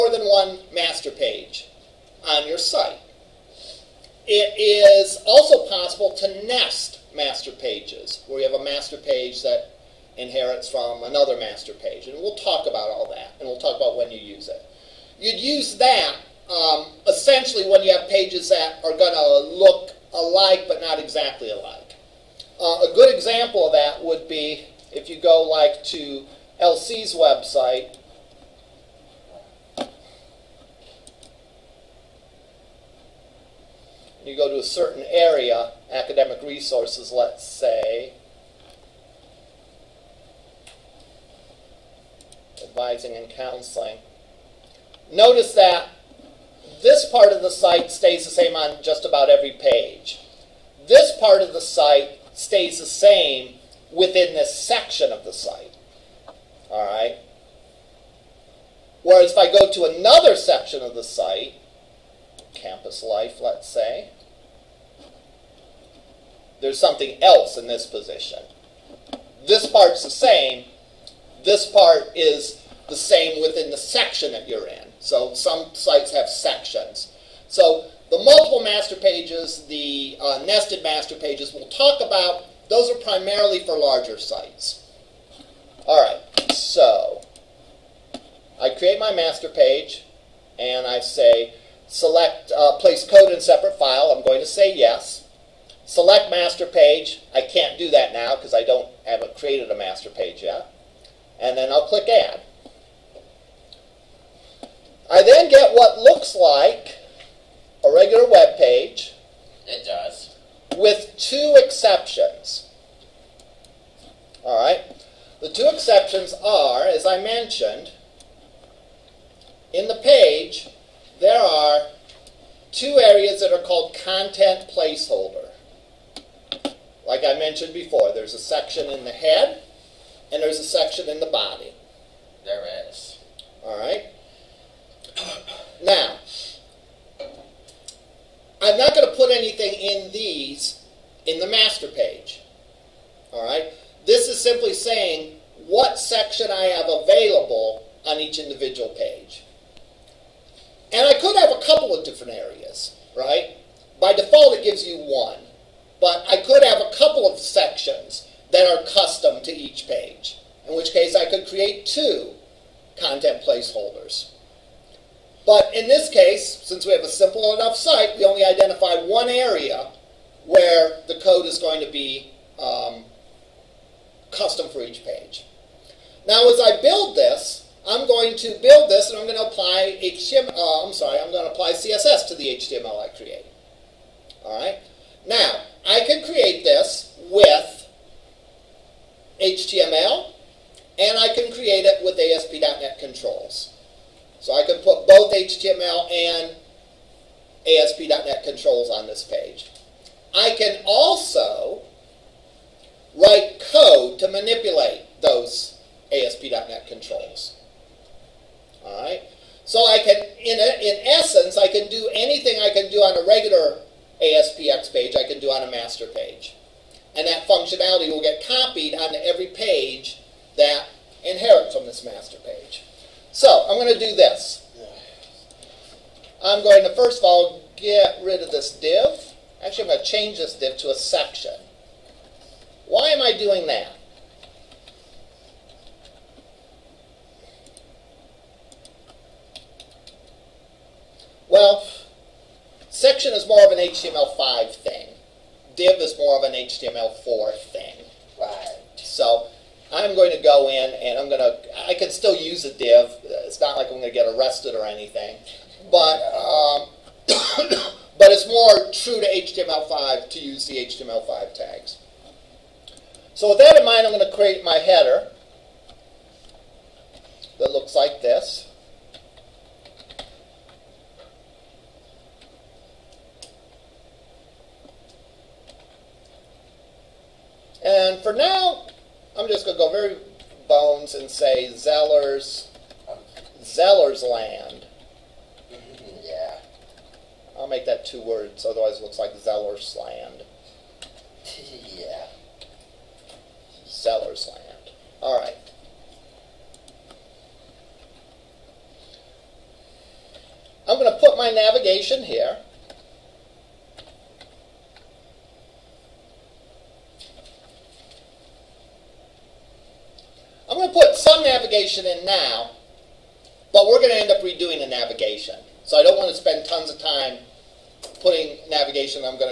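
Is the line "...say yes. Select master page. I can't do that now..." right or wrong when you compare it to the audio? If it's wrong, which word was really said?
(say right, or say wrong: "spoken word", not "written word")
right.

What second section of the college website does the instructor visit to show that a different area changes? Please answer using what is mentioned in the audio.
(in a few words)
Campus life.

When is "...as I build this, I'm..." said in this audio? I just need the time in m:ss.
2:56.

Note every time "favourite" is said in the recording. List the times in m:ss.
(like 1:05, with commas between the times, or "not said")
not said.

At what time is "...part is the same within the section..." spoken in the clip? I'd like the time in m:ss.
1:11.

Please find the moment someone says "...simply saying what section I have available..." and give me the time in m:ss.
2:24.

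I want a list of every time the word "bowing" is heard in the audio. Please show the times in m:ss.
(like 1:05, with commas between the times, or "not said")
not said.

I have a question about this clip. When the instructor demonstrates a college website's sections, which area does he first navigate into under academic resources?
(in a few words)
Advising and counseling.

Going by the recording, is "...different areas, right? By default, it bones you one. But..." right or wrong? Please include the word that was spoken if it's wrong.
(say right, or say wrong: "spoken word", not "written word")
wrong: "gives", not "bones".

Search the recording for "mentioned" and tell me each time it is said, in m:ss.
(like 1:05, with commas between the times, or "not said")
1:57, 2:07.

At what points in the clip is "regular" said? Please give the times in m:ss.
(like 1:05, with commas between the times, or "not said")
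1:47, 3:33.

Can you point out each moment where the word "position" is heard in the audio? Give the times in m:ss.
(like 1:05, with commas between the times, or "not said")
1:07.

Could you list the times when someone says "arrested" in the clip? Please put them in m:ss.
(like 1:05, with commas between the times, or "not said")
4:14.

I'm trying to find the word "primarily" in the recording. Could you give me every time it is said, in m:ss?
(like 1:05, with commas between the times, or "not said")
1:22.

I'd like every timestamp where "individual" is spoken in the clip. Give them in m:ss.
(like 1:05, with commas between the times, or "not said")
2:28.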